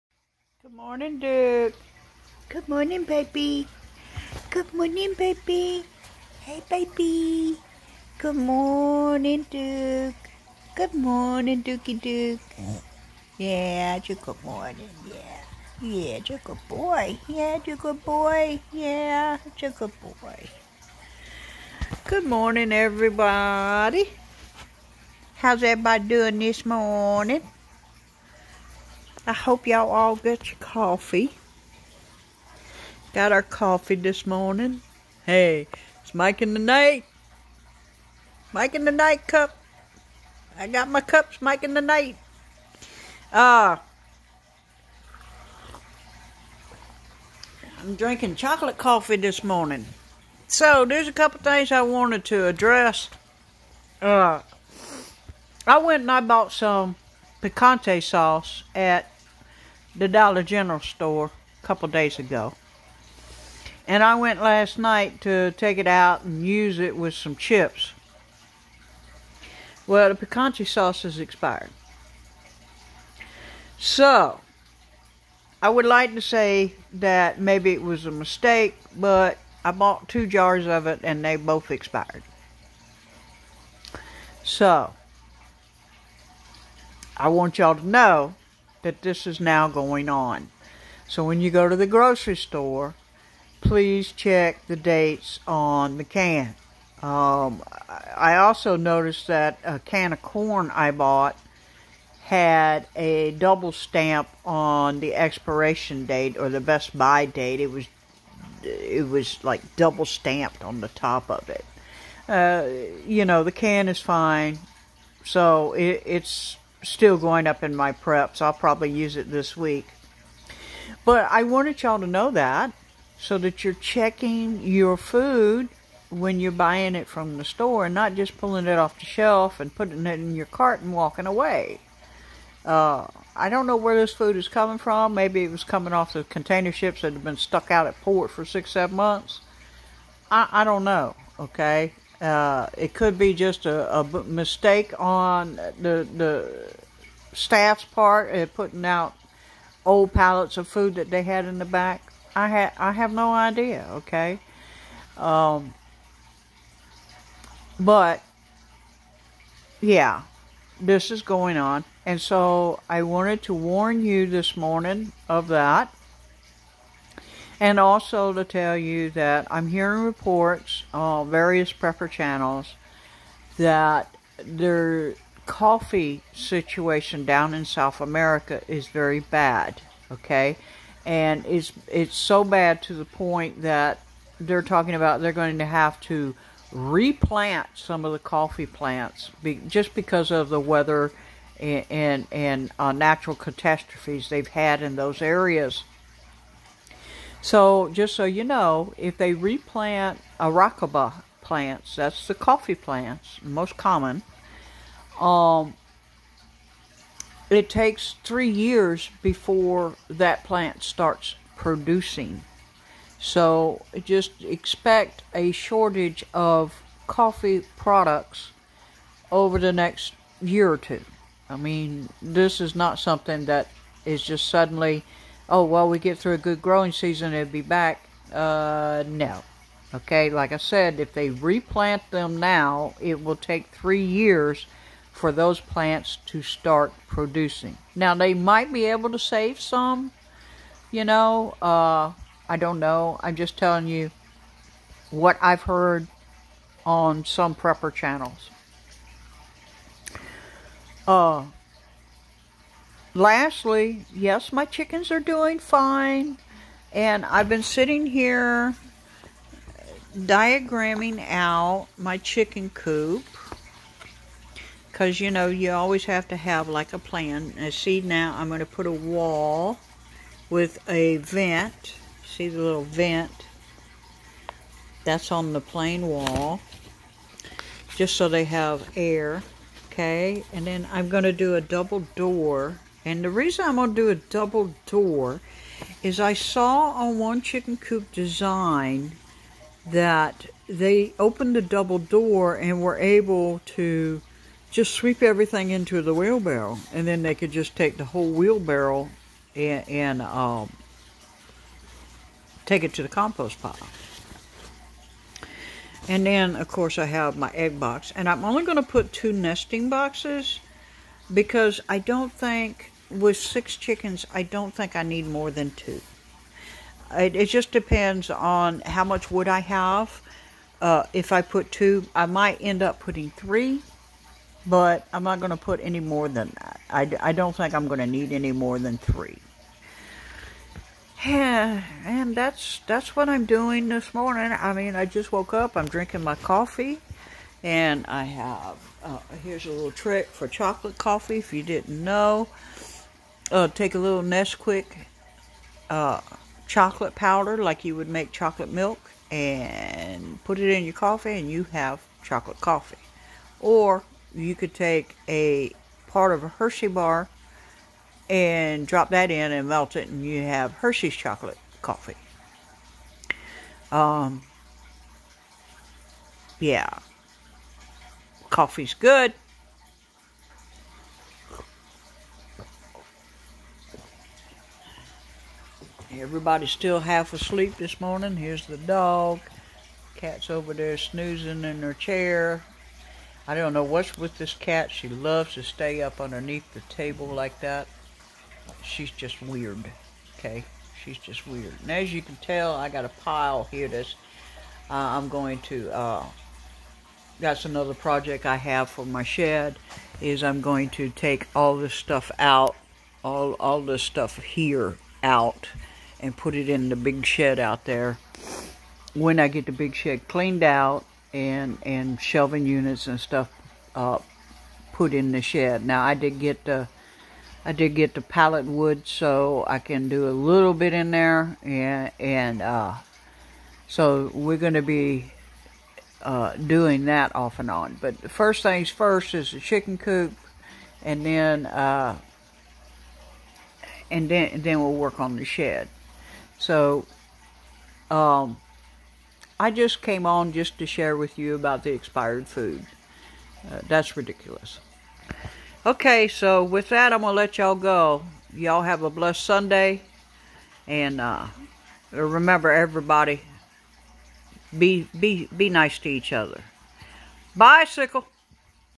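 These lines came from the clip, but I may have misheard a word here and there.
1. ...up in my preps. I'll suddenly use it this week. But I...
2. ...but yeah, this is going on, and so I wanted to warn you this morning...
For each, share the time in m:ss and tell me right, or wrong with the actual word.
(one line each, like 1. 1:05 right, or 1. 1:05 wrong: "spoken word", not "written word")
1. 1:57 wrong: "probably", not "suddenly"
2. 2:37 right.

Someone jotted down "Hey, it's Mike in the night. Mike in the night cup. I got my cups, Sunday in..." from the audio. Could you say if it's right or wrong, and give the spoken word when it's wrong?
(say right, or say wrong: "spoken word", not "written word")
wrong: "Mike", not "Sunday".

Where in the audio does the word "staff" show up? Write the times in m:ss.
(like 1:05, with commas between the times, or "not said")
2:27.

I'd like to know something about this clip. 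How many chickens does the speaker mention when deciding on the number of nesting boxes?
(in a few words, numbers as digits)
6.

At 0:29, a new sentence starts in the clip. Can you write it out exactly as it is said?
I hope y'all all got your coffee.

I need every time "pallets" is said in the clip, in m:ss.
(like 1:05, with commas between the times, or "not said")
2:30, 6:58.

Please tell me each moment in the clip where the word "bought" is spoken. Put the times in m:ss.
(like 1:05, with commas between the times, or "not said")
0:56, 1:19, 1:40.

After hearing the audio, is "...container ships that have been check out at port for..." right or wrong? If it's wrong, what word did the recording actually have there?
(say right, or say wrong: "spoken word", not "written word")
wrong: "stuck", not "check".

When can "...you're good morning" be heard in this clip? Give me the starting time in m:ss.
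0:14.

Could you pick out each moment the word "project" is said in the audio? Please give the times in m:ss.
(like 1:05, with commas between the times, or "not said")
6:37.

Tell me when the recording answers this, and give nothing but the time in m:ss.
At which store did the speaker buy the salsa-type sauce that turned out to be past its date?
1:00.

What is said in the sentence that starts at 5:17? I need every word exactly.
It, it just depends on how much wood I have.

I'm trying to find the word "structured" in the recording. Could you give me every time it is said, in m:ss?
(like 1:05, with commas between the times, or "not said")
not said.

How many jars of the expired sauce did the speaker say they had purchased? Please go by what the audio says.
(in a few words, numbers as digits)
2.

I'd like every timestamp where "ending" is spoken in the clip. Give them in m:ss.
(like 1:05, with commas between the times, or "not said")
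not said.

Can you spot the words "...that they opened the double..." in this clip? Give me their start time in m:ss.
4:49.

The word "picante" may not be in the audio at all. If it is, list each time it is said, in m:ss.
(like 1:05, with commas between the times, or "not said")
0:57, 1:10.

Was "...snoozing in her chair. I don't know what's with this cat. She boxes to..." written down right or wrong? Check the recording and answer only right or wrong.
wrong.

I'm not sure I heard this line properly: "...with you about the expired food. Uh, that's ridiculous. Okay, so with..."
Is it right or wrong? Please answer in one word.
right.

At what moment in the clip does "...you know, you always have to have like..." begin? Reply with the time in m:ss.
4:25.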